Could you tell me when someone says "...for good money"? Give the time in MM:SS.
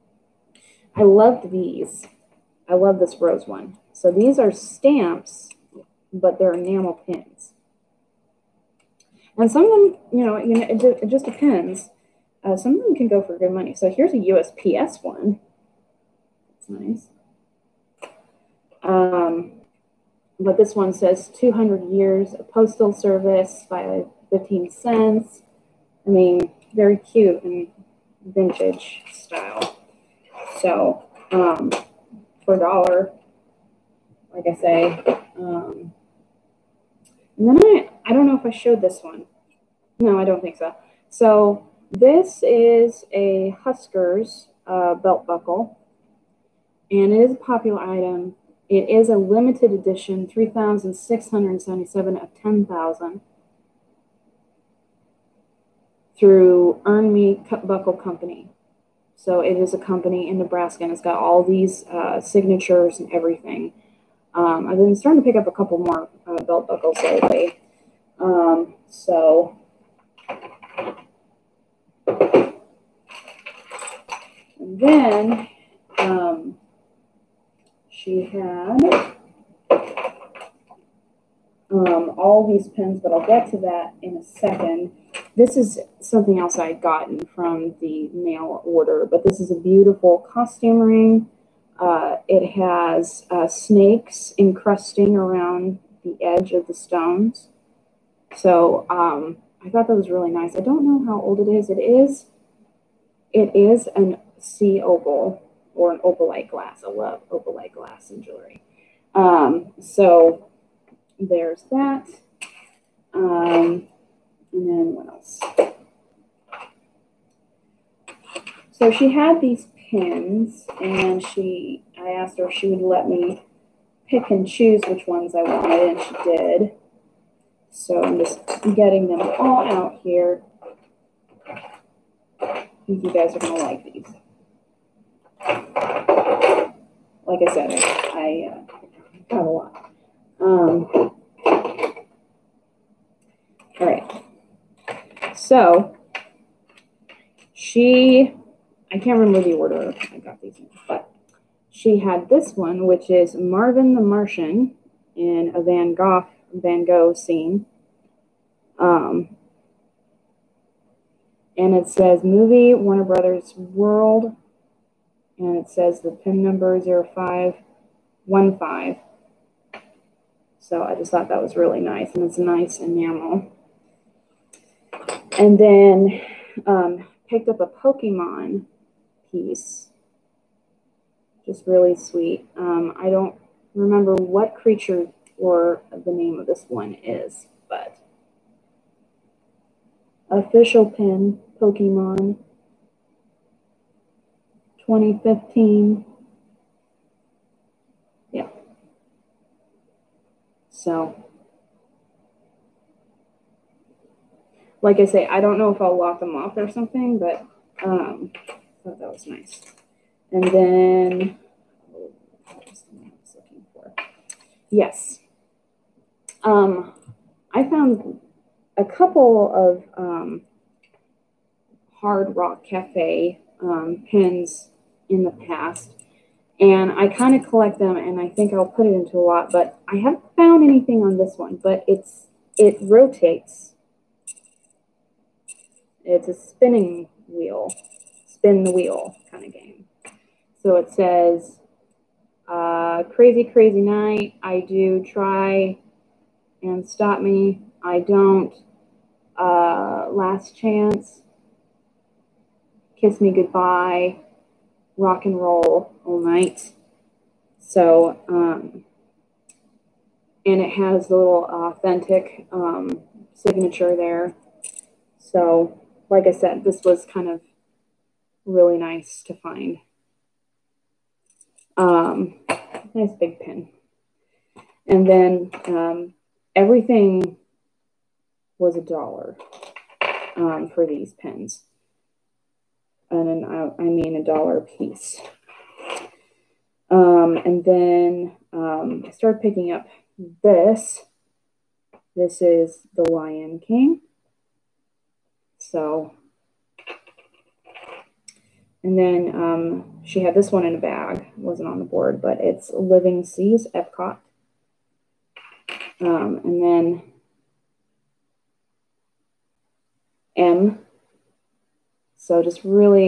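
00:13.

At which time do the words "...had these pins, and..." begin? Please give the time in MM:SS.
01:59.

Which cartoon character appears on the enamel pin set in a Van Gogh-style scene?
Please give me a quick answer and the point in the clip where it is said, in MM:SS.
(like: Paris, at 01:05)
Marvin the Martian, at 02:33.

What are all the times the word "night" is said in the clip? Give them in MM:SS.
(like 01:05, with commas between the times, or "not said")
04:03, 04:16.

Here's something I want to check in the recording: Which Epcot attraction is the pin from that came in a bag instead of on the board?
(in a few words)
Living Seas.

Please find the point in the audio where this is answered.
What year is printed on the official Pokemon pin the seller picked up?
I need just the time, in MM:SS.
03:14.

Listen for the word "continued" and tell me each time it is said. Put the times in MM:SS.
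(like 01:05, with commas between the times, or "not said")
not said.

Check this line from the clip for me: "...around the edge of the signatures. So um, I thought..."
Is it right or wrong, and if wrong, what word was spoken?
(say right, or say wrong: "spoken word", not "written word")
wrong: "stones", not "signatures".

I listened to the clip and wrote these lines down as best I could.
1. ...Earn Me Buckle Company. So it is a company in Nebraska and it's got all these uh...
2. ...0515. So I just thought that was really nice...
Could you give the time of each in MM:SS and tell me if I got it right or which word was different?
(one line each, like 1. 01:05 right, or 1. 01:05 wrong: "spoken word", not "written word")
1. 00:56 right
2. 02:46 right.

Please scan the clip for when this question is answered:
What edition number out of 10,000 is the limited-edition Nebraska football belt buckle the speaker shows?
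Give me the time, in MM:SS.
00:50.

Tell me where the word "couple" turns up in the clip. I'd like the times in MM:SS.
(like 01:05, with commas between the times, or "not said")
01:05, 03:38.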